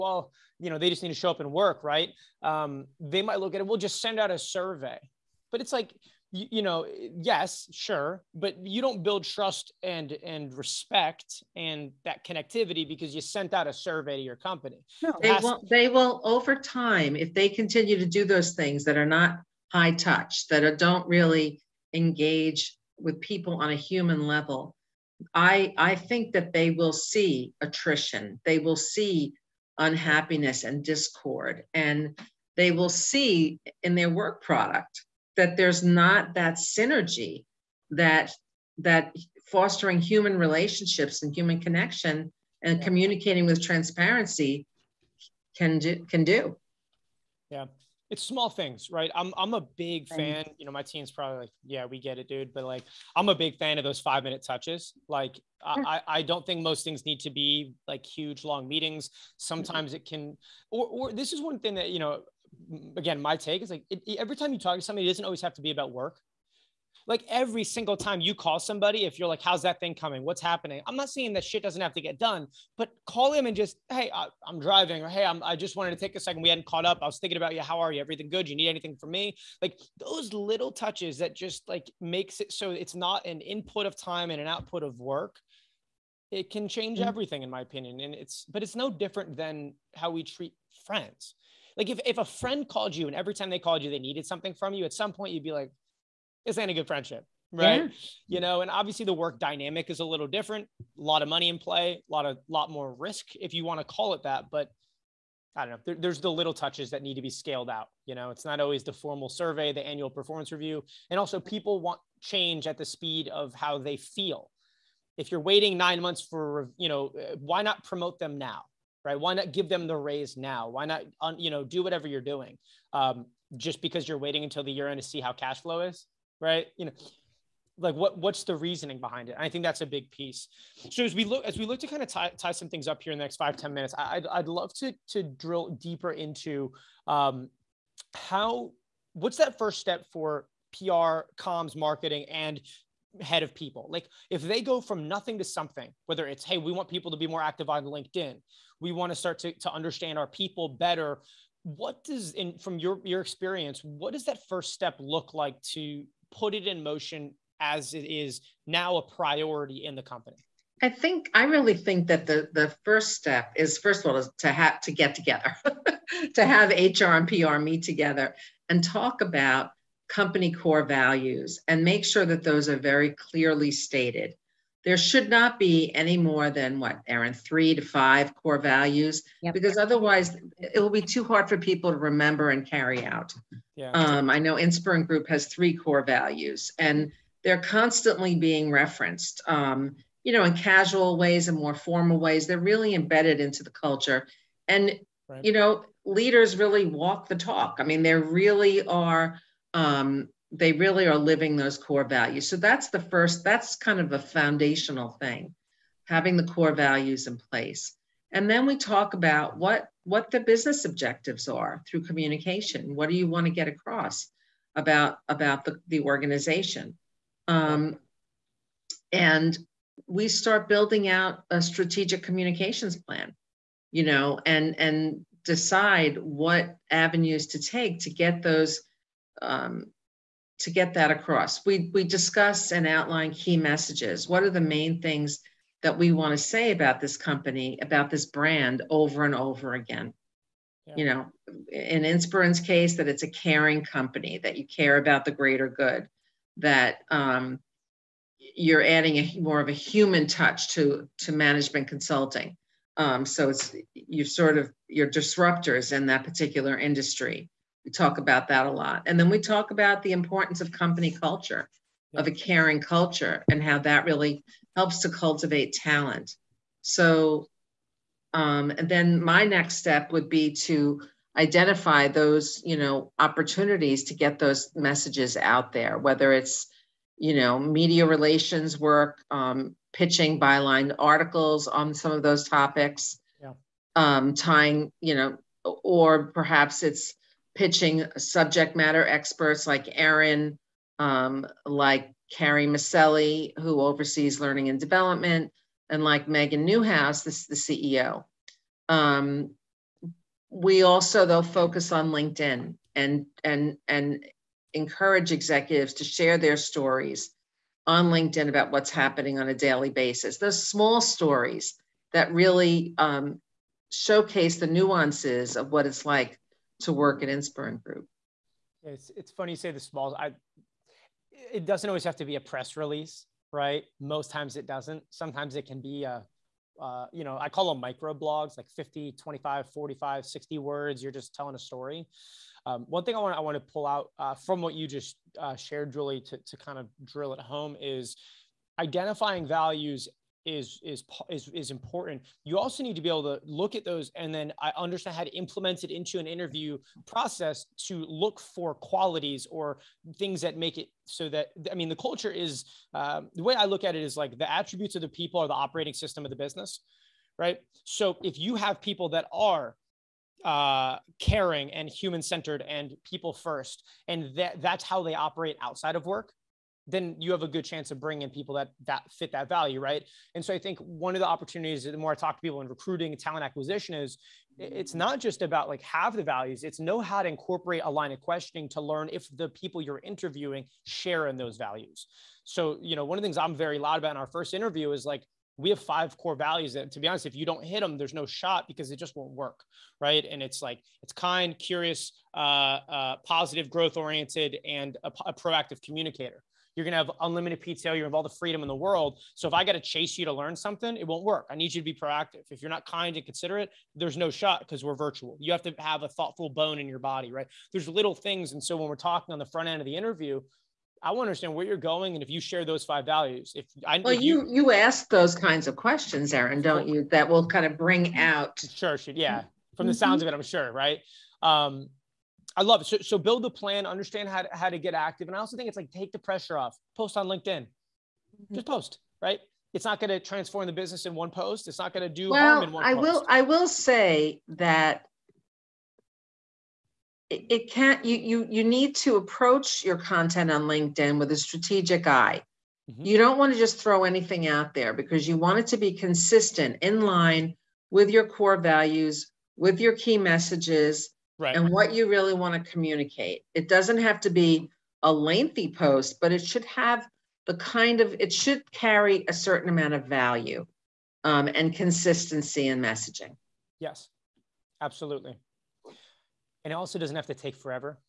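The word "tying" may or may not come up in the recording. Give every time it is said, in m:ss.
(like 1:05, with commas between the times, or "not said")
4:44.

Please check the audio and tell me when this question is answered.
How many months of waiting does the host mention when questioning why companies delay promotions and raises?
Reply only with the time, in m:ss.
1:55.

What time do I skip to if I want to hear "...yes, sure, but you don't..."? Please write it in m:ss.
0:07.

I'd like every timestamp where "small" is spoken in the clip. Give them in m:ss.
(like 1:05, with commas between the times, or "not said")
0:48, 5:10, 5:19.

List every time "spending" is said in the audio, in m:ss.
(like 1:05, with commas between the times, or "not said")
not said.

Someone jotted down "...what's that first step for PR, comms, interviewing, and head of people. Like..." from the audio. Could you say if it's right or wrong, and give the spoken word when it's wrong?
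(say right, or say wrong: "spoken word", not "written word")
wrong: "marketing", not "interviewing".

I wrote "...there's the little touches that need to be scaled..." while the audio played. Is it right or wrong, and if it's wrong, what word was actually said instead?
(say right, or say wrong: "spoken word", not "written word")
right.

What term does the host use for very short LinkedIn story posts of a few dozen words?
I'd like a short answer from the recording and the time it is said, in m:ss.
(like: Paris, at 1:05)
micro blogs, at 5:27.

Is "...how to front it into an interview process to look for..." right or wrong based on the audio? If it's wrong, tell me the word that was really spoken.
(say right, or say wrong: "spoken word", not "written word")
wrong: "implement", not "front".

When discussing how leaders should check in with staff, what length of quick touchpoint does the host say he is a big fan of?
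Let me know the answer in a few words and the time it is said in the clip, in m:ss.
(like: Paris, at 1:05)
5 minutes, at 0:53.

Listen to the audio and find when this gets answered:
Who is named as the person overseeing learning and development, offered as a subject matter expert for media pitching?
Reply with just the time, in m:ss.
4:52.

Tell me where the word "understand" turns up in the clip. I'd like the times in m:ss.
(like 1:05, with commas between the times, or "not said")
2:29, 5:44, 6:51, 7:03.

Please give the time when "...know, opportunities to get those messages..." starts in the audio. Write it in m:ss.
4:32.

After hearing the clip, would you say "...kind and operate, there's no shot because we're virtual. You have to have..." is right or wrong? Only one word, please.
wrong.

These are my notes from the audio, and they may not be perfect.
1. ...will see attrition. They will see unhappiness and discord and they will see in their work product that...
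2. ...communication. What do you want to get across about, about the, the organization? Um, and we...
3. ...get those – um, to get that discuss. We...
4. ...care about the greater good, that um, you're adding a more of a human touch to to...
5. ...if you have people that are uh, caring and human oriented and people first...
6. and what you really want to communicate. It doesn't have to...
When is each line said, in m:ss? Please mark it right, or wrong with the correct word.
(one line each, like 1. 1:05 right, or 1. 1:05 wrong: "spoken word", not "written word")
1. 0:26 right
2. 3:32 right
3. 3:48 wrong: "across", not "discuss"
4. 4:04 right
5. 5:58 wrong: "centered", not "oriented"
6. 7:31 right.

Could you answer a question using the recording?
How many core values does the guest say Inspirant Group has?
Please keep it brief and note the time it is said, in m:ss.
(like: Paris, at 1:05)
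3, at 3:05.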